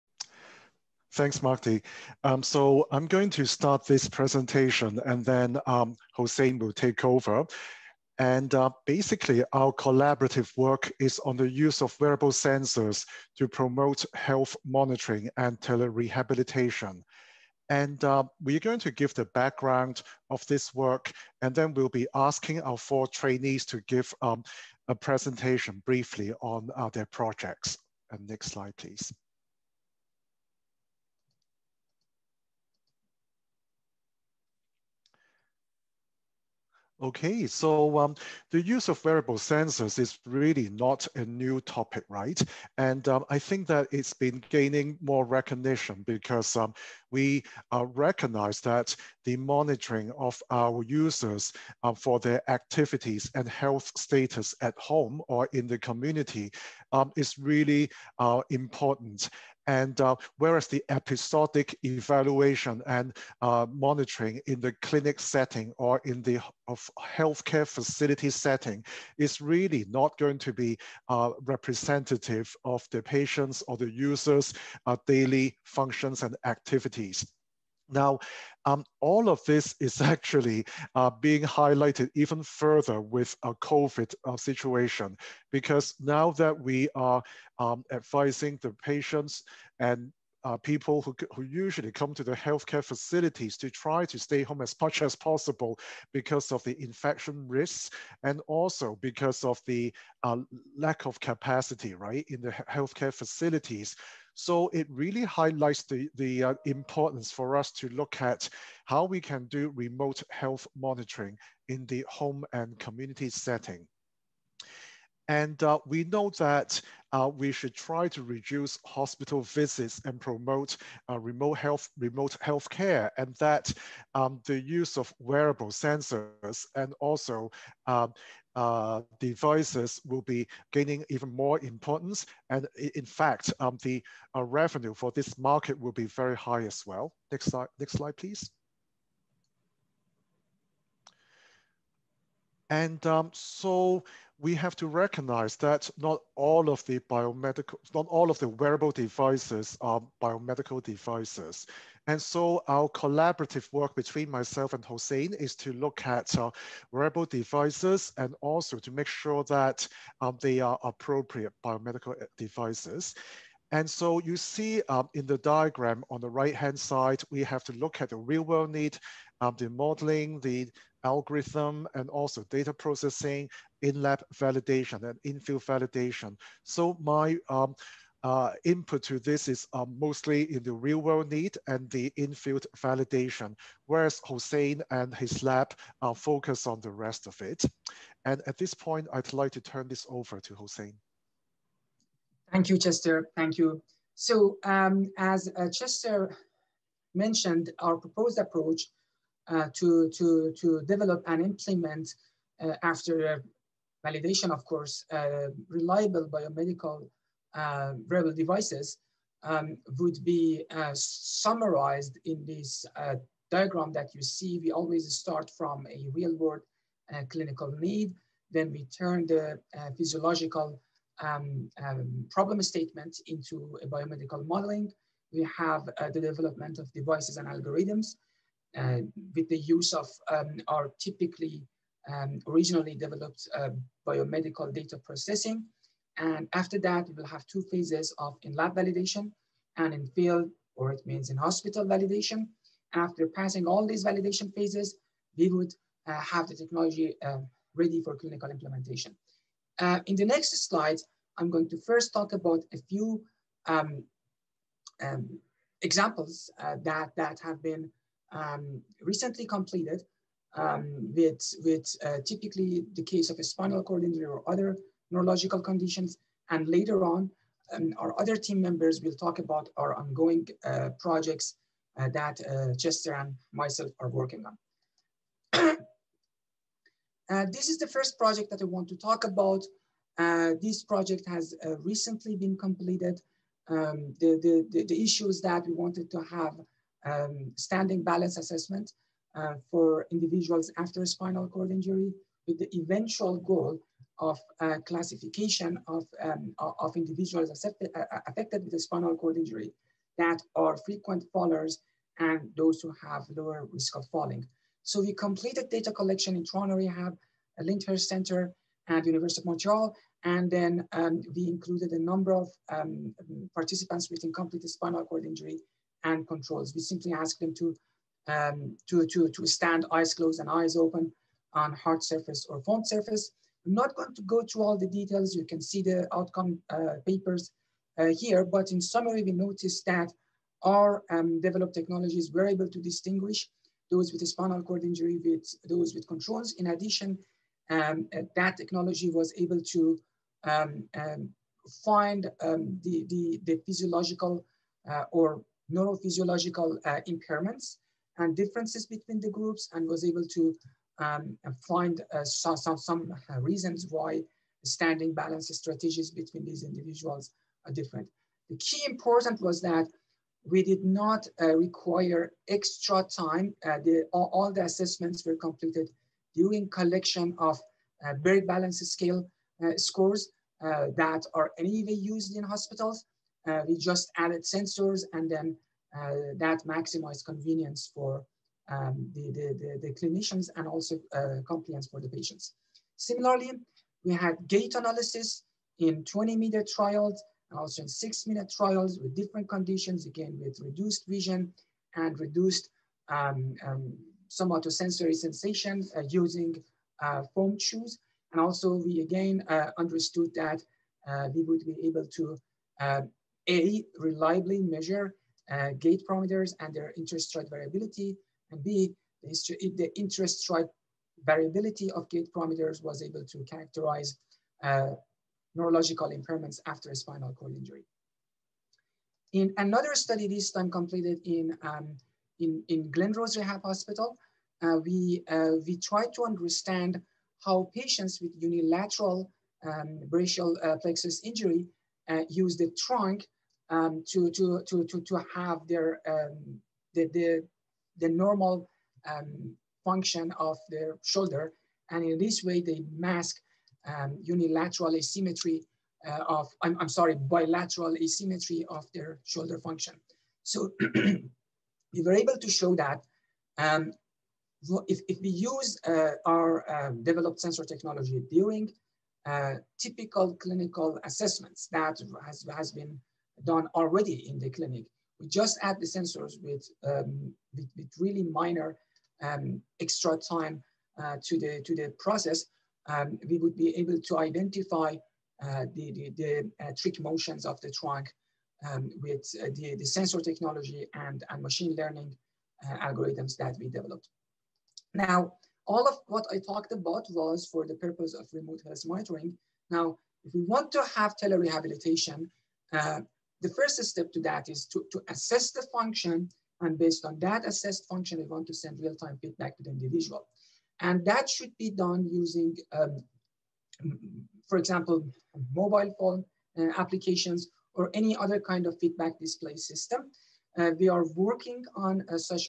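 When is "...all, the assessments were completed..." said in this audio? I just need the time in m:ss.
6:04.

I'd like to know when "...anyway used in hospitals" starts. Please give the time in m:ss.
6:11.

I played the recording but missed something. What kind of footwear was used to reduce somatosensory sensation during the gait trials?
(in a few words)
Foam shoes.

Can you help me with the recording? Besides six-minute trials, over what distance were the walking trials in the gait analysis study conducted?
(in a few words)
20 meters.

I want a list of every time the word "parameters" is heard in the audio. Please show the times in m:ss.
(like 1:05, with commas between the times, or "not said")
6:46, 6:52.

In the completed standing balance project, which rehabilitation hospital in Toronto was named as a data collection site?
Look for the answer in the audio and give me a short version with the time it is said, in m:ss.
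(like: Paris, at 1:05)
Lyndhurst Center, at 5:07.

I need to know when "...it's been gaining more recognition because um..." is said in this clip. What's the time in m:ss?
0:43.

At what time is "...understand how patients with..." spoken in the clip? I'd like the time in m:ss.
7:06.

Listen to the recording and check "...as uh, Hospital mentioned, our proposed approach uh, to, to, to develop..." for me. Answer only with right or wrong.
wrong.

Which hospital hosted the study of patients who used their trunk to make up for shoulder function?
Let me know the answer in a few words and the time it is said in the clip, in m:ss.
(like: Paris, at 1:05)
Glenrose Rehab Hospital, at 7:02.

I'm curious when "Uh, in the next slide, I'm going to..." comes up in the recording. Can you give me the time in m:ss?
4:09.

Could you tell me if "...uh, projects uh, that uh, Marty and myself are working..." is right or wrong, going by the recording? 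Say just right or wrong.
wrong.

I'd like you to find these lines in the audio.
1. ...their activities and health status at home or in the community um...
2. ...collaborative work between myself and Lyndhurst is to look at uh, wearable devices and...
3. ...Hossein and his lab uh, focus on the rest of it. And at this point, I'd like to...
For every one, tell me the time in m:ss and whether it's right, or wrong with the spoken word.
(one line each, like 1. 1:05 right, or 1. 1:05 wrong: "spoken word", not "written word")
1. 0:52 right
2. 2:32 wrong: "Hossein", not "Lyndhurst"
3. 3:04 right.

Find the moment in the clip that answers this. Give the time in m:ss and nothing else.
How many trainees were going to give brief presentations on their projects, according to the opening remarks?
0:22.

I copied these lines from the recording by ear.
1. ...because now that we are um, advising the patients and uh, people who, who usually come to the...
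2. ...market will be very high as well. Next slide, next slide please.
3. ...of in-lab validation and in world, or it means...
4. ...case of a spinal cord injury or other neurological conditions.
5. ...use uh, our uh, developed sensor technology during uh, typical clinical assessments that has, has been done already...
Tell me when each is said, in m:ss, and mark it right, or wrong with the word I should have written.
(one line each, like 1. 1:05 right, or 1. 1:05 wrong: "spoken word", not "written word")
1. 1:25 right
2. 2:15 right
3. 3:58 wrong: "field", not "world"
4. 4:23 right
5. 7:35 right.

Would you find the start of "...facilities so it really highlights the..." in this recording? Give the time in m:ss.
1:43.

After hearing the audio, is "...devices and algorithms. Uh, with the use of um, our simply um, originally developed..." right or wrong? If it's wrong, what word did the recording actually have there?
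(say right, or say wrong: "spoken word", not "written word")
wrong: "typically", not "simply".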